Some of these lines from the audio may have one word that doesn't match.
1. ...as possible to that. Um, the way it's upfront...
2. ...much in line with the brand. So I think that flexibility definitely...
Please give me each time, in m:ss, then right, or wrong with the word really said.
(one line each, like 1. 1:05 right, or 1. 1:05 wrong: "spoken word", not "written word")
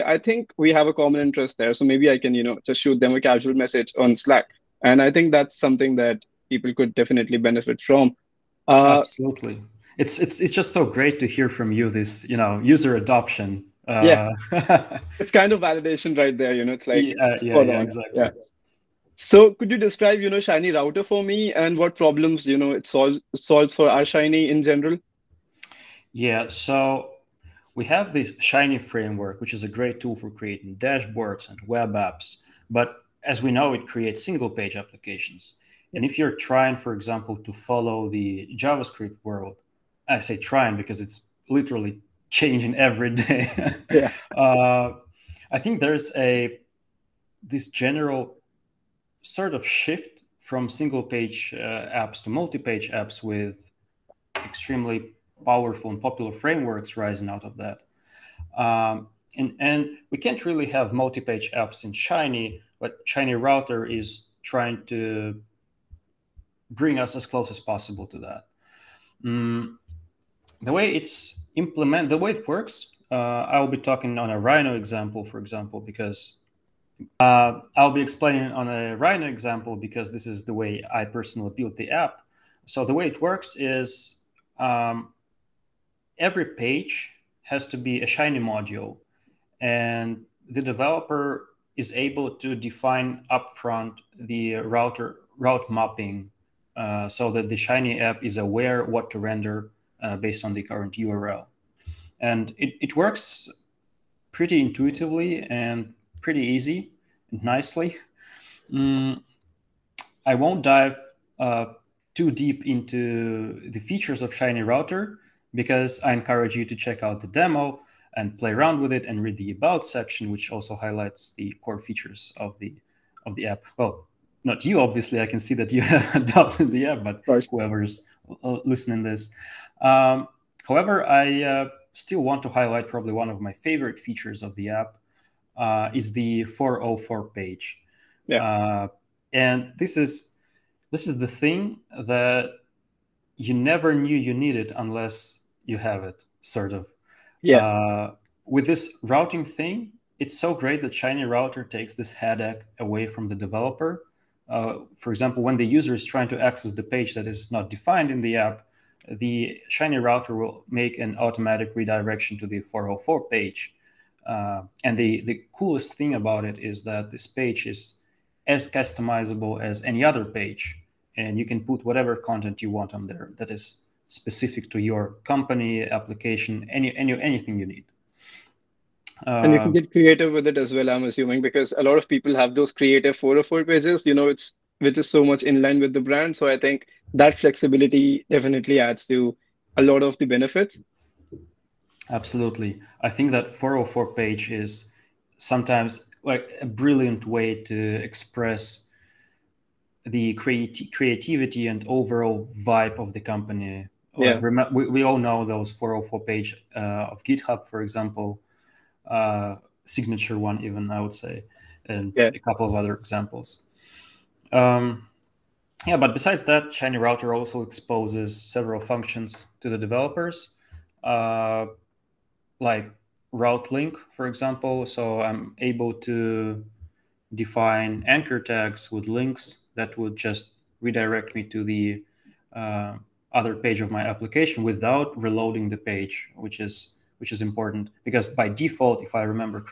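1. 1:07 wrong: "implement", not "upfront"
2. 3:05 right.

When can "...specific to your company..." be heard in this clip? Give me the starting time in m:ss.
2:54.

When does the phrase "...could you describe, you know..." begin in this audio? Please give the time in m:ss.
0:19.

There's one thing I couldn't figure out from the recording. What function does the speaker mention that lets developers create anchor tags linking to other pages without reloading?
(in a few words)
route link.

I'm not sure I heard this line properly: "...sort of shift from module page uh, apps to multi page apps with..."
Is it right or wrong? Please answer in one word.
wrong.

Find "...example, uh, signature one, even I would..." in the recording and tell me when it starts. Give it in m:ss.
3:27.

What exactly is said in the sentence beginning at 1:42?
And it, it works pretty intuitively and pretty easy and nicely.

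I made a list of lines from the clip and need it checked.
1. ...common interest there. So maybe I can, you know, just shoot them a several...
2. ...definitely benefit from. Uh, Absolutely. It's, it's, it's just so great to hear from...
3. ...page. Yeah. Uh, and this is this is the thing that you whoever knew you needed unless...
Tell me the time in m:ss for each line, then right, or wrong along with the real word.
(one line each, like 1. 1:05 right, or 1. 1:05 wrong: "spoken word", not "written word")
1. 0:00 wrong: "casual", not "several"
2. 0:06 right
3. 2:17 wrong: "never", not "whoever".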